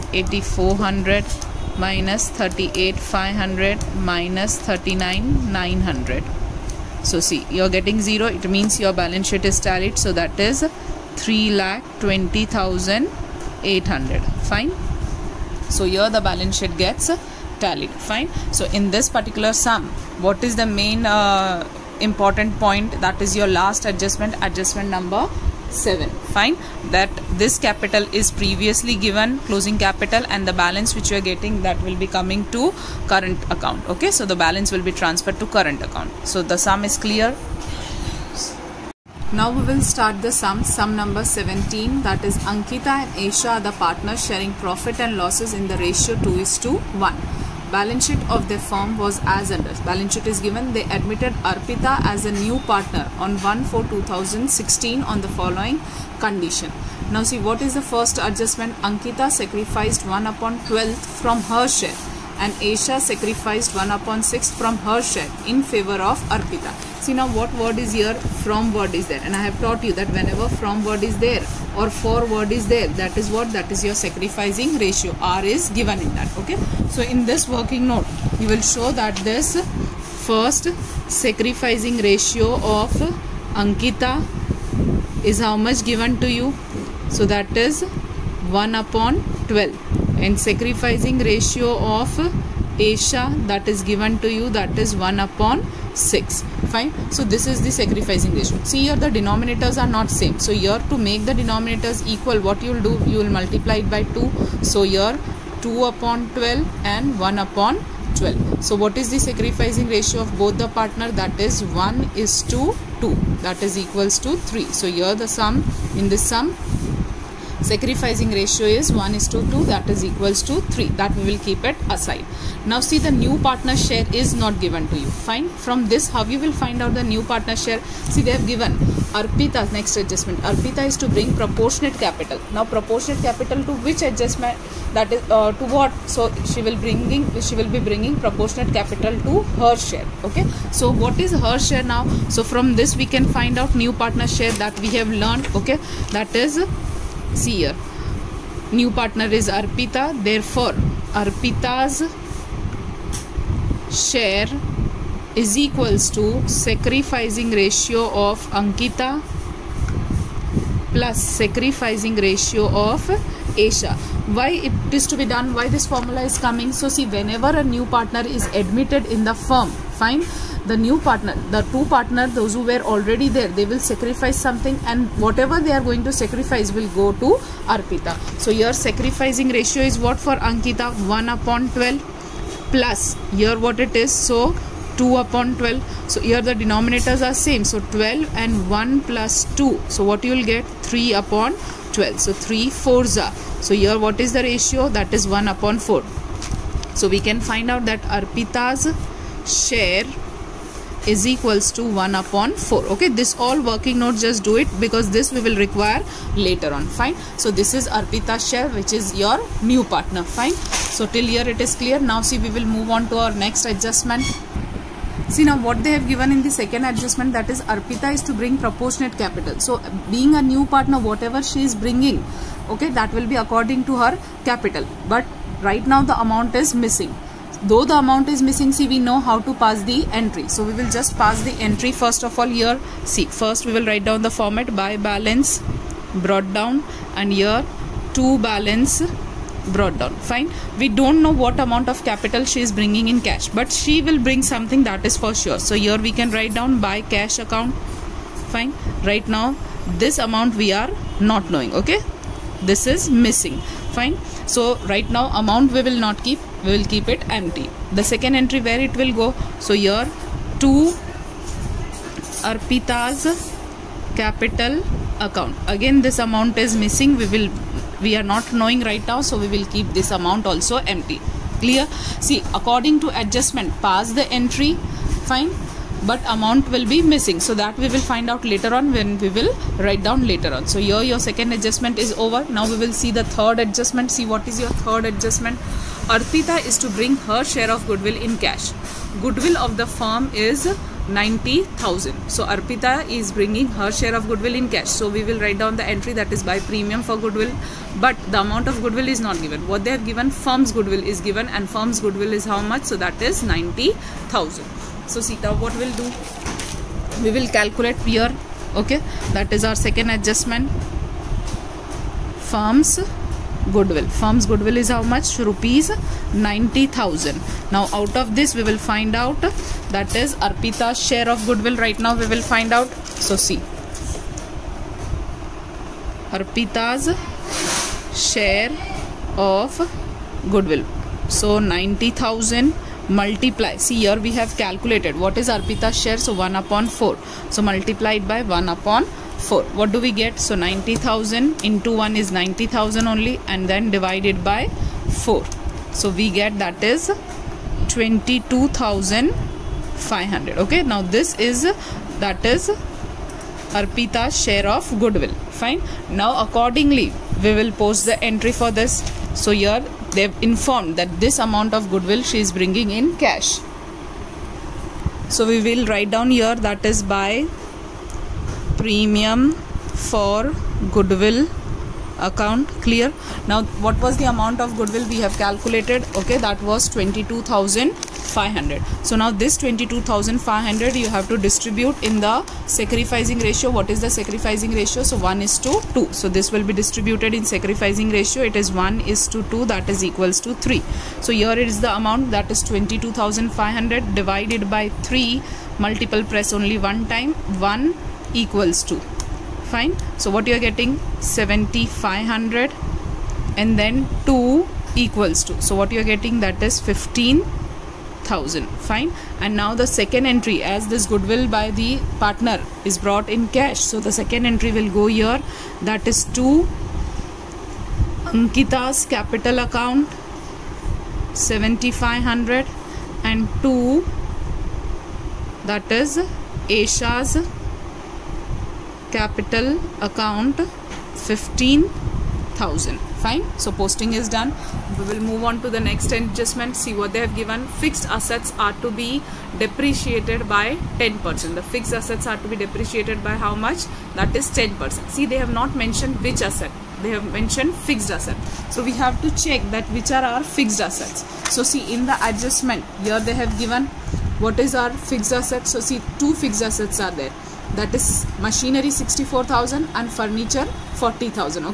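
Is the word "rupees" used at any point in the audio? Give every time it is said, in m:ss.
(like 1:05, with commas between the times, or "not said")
5:15.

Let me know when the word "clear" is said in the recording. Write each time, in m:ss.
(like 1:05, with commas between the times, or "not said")
0:37, 3:31, 4:31, 6:12.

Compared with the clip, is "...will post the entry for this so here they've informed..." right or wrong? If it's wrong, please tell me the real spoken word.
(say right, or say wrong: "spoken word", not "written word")
right.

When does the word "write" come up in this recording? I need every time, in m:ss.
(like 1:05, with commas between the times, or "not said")
3:53, 4:06, 4:39, 4:55, 6:05.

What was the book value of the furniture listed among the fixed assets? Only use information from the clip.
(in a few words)
40000.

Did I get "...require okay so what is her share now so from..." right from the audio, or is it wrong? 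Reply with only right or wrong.
wrong.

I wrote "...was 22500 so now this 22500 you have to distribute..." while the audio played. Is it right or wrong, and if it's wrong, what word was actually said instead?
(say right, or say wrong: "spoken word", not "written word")
right.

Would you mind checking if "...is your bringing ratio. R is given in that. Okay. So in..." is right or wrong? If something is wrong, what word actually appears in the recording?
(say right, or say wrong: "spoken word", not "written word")
wrong: "sacrificing", not "bringing".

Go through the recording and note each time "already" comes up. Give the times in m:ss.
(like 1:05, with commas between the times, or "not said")
2:52.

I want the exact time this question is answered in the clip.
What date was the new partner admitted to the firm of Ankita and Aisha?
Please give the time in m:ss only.
0:53.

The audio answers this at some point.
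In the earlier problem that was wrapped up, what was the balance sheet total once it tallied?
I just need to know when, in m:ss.
0:11.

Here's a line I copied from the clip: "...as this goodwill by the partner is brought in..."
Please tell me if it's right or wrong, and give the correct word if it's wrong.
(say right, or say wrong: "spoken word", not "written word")
right.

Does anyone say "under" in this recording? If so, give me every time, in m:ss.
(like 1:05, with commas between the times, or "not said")
0:49.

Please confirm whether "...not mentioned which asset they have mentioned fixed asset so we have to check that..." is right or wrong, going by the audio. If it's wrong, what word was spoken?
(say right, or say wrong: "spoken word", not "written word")
right.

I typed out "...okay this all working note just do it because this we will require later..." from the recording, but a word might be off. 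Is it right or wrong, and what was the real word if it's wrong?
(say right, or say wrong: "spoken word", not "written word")
right.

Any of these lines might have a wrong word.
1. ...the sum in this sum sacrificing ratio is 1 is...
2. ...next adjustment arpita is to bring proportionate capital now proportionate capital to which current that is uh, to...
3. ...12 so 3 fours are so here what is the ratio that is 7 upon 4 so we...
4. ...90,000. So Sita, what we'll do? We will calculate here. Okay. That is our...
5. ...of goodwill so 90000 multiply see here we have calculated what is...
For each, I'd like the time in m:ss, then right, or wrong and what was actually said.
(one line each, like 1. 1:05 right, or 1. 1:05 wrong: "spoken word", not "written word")
1. 1:55 right
2. 2:09 wrong: "adjustment", not "current"
3. 3:11 wrong: "1", not "7"
4. 5:03 right
5. 5:29 right.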